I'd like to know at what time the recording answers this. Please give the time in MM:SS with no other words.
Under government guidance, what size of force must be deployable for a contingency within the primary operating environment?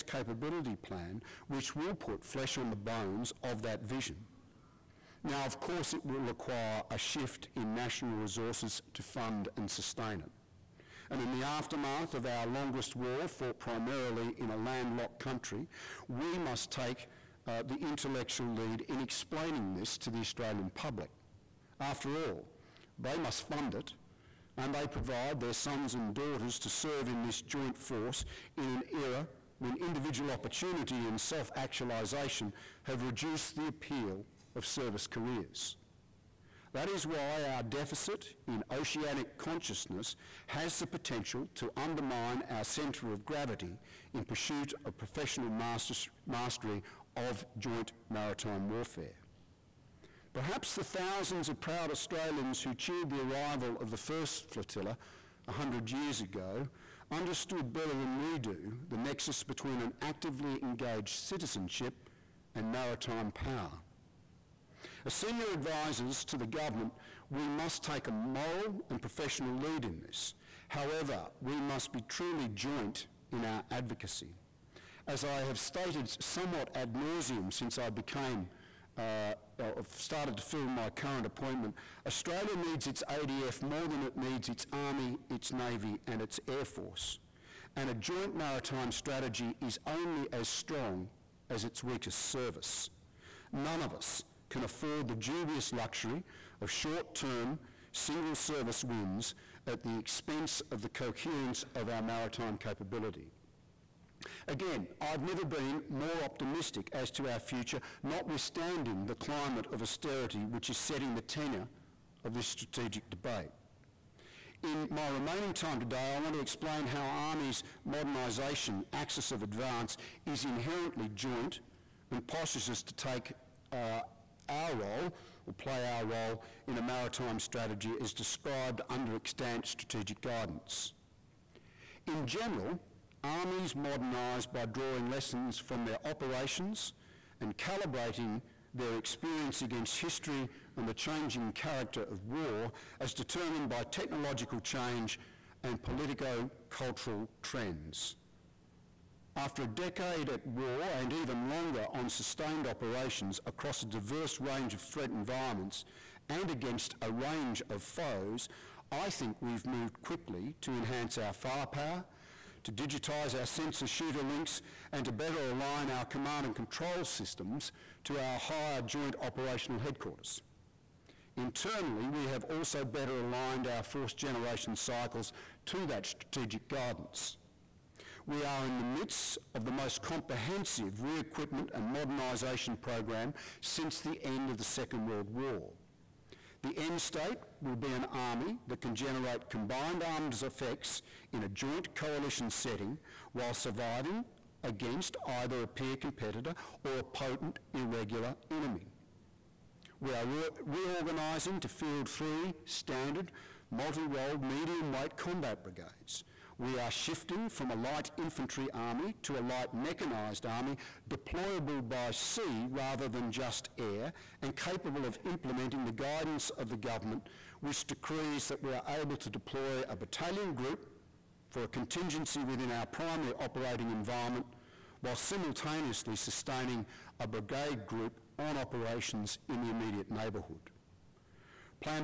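03:39.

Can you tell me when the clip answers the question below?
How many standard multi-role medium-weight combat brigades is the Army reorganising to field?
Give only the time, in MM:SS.
03:22.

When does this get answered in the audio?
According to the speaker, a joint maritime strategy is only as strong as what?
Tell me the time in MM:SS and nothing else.
01:31.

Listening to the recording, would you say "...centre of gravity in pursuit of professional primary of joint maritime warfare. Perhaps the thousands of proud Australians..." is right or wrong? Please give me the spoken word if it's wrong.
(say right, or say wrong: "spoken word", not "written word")
wrong: "mastery", not "primary".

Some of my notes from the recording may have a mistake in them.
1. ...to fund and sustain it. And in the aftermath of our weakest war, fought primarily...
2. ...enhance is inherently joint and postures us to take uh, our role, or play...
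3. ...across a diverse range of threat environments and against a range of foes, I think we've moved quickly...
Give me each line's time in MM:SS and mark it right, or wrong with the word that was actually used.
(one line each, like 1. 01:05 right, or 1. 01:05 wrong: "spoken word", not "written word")
1. 00:08 wrong: "longest", not "weakest"
2. 01:59 wrong: "advance", not "enhance"
3. 02:33 right.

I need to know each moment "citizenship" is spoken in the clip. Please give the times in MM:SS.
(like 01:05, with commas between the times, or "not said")
01:01.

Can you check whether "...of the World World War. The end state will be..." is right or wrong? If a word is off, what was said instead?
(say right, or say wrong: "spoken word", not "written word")
wrong: "Second", not "World".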